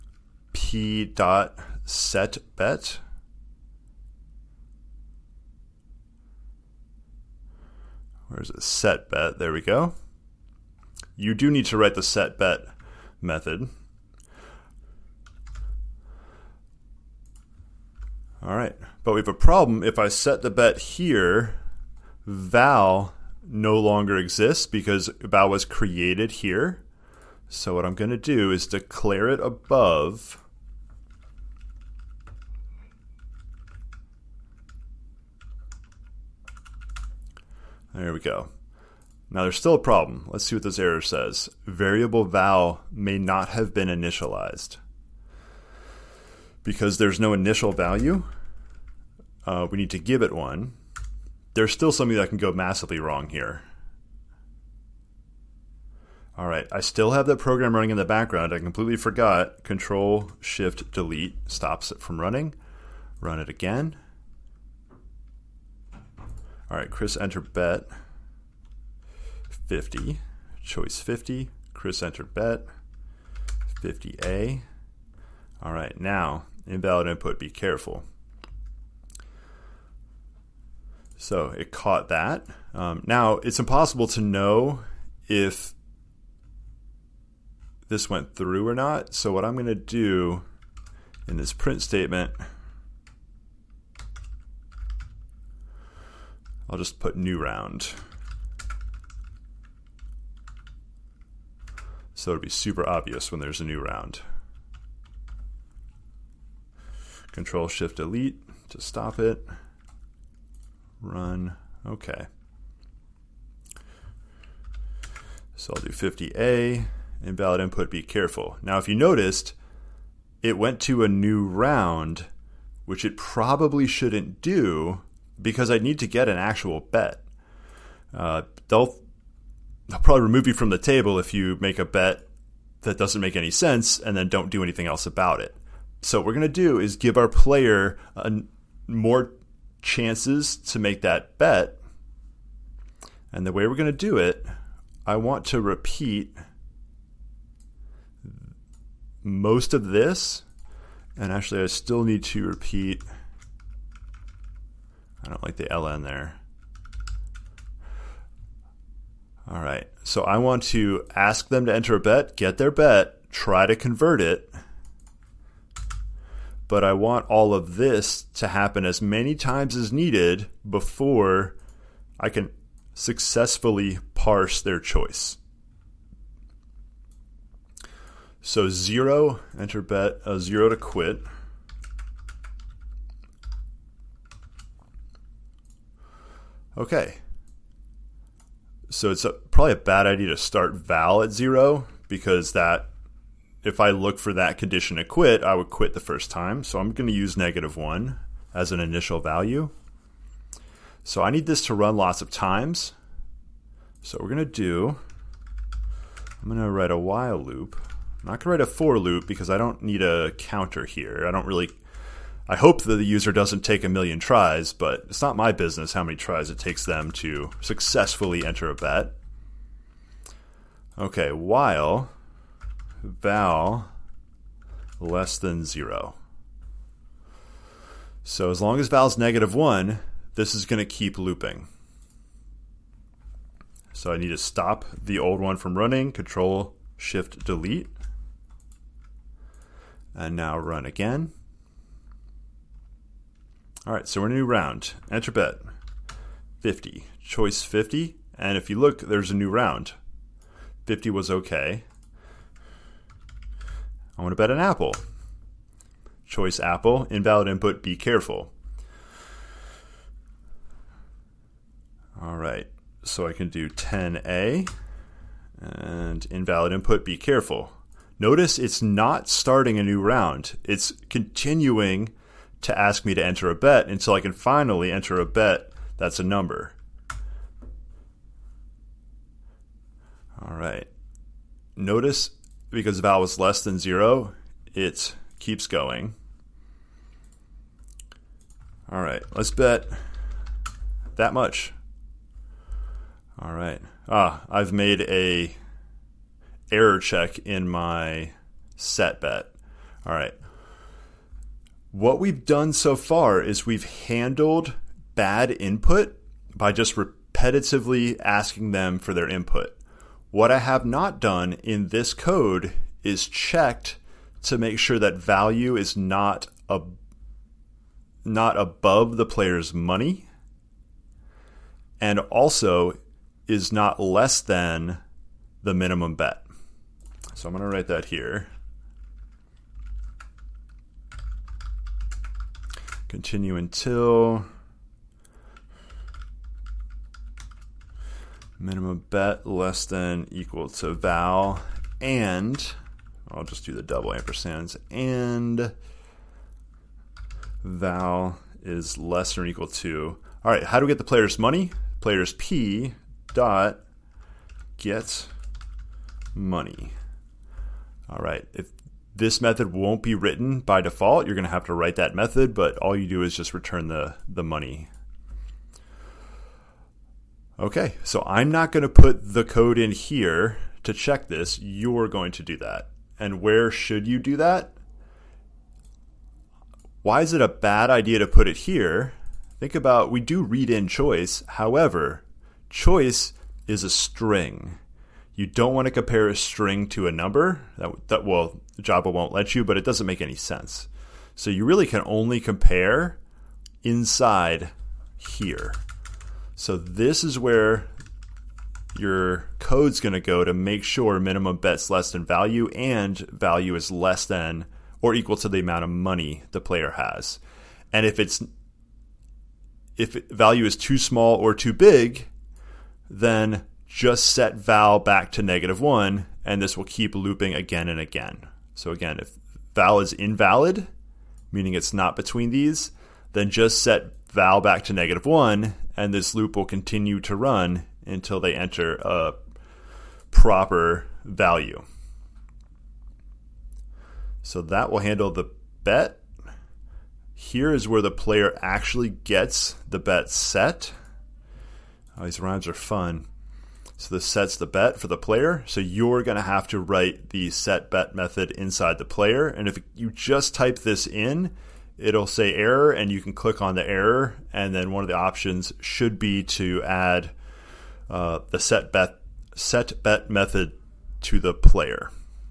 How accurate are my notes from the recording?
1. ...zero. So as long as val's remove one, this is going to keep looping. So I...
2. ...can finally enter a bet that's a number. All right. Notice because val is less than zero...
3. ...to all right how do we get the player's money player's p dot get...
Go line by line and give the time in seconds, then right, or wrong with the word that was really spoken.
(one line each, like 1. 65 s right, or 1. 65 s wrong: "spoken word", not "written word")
1. 225 s wrong: "negative", not "remove"
2. 274 s right
3. 349 s right.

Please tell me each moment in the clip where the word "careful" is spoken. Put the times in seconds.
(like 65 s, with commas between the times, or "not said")
77 s, 118 s, 257 s, 267 s.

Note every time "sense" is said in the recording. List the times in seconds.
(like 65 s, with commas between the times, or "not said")
133 s, 390 s.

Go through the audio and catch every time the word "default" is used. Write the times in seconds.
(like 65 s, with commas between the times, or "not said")
360 s.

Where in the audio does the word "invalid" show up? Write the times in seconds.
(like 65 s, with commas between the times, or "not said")
76 s, 117 s, 257 s, 266 s, 420 s.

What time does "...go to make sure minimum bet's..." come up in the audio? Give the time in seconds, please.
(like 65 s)
400 s.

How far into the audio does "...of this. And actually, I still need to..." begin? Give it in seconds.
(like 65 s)
149 s.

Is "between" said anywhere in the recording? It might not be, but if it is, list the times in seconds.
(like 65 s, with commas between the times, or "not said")
422 s.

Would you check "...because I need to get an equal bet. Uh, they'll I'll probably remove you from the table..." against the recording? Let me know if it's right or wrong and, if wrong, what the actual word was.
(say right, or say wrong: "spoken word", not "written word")
wrong: "actual", not "equal".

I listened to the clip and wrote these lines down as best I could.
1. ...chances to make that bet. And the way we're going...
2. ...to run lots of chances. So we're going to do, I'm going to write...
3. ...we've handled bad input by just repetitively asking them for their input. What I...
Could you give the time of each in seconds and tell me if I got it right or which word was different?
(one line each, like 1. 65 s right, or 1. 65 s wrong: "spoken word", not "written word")
1. 139 s right
2. 201 s wrong: "times", not "chances"
3. 303 s right.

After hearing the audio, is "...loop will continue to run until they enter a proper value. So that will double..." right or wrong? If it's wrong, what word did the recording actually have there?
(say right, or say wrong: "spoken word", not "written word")
wrong: "handle", not "double".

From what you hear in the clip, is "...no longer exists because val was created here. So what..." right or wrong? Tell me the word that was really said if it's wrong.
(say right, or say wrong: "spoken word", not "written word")
right.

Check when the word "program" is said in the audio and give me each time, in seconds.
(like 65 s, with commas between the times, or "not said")
57 s.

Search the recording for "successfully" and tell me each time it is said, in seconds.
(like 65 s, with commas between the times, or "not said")
172 s, 217 s.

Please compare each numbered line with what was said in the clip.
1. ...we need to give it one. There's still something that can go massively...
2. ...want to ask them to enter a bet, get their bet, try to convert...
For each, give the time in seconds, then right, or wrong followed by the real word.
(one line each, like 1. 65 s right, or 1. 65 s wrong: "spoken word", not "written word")
1. 49 s right
2. 160 s right.